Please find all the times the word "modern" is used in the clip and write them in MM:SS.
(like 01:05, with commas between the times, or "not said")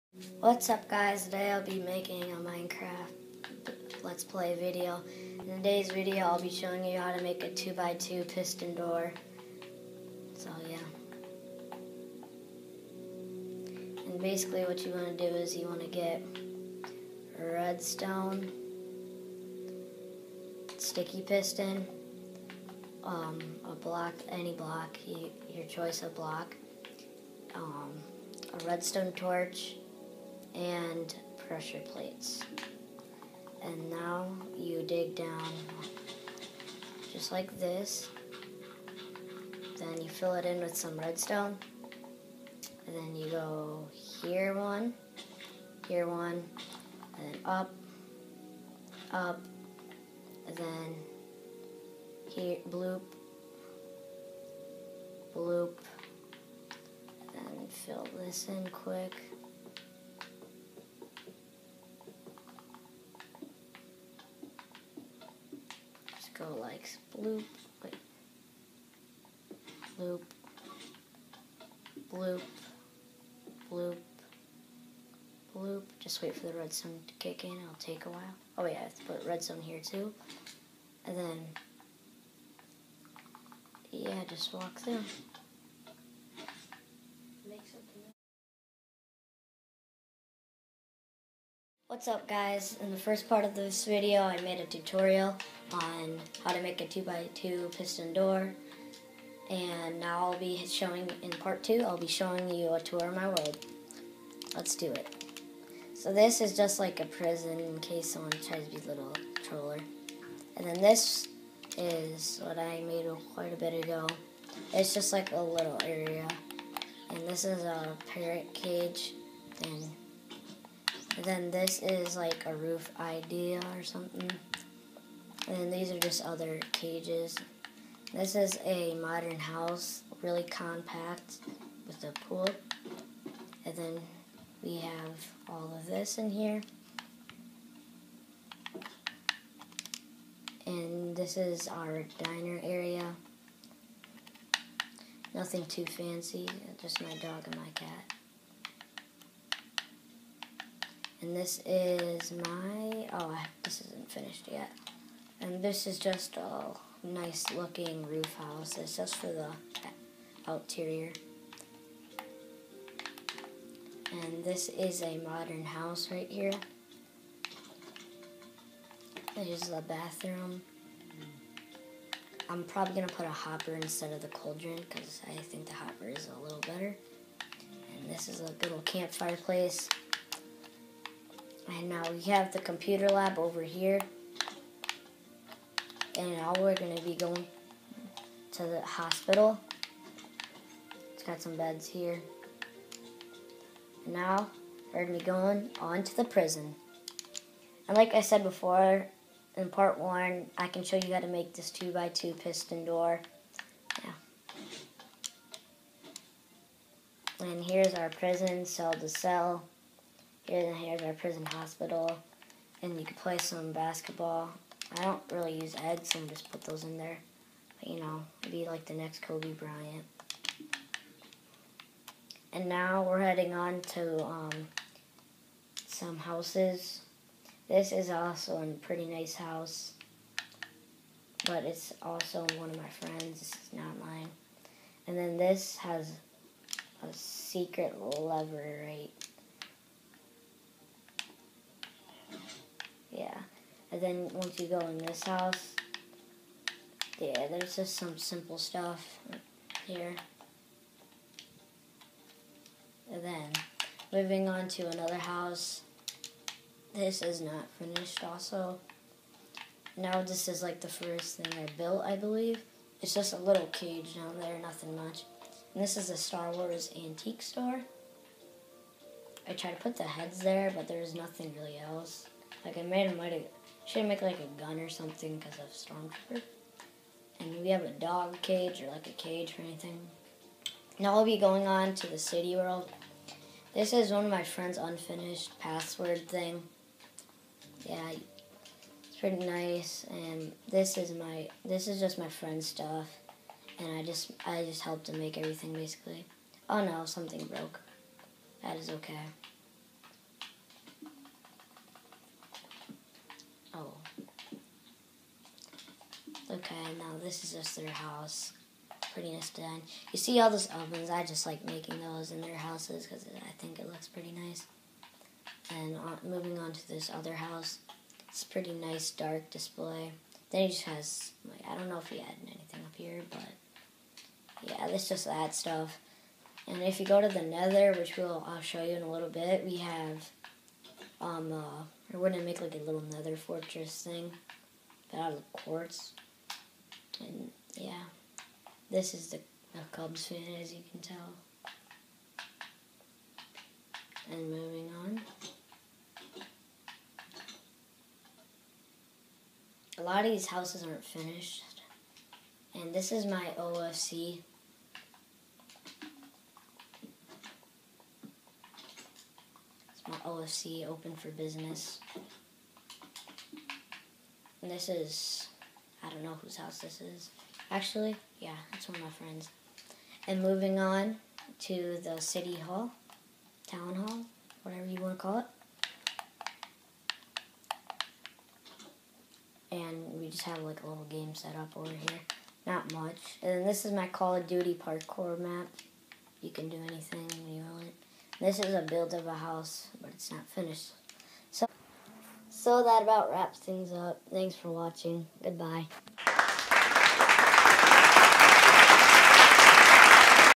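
02:08, 02:45.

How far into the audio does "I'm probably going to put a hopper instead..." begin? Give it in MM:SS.
02:52.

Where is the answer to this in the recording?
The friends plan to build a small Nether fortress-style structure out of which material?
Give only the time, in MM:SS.
05:35.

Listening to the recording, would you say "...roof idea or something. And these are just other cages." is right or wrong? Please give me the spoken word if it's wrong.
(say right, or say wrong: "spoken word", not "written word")
right.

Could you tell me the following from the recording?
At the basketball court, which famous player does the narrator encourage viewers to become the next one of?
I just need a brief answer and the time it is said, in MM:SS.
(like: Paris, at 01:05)
Kobe Bryant, at 03:39.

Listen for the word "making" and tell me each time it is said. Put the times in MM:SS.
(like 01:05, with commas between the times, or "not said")
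00:01, 05:11.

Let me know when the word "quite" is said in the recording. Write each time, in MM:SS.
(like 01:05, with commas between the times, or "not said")
01:53.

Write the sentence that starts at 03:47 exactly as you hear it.
This is also a pretty nice house.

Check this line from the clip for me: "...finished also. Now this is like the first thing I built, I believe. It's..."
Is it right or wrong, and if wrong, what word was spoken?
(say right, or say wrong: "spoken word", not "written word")
right.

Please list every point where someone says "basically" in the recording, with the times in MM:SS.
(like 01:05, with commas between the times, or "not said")
00:14, 04:55.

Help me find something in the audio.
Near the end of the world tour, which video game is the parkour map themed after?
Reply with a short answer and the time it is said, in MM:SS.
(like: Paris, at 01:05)
Call of Duty, at 06:24.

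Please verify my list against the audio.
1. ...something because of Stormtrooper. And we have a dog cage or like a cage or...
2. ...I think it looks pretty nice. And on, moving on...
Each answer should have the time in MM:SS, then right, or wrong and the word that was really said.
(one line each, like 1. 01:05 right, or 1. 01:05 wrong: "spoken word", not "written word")
1. 04:34 right
2. 05:13 right.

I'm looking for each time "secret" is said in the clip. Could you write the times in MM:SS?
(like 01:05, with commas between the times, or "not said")
03:57.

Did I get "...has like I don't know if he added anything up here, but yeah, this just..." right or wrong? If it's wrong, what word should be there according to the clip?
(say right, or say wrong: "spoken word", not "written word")
right.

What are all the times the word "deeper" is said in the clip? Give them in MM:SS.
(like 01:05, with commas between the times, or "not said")
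not said.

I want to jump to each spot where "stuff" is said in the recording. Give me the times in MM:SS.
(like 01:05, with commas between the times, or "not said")
04:08, 04:52, 05:25.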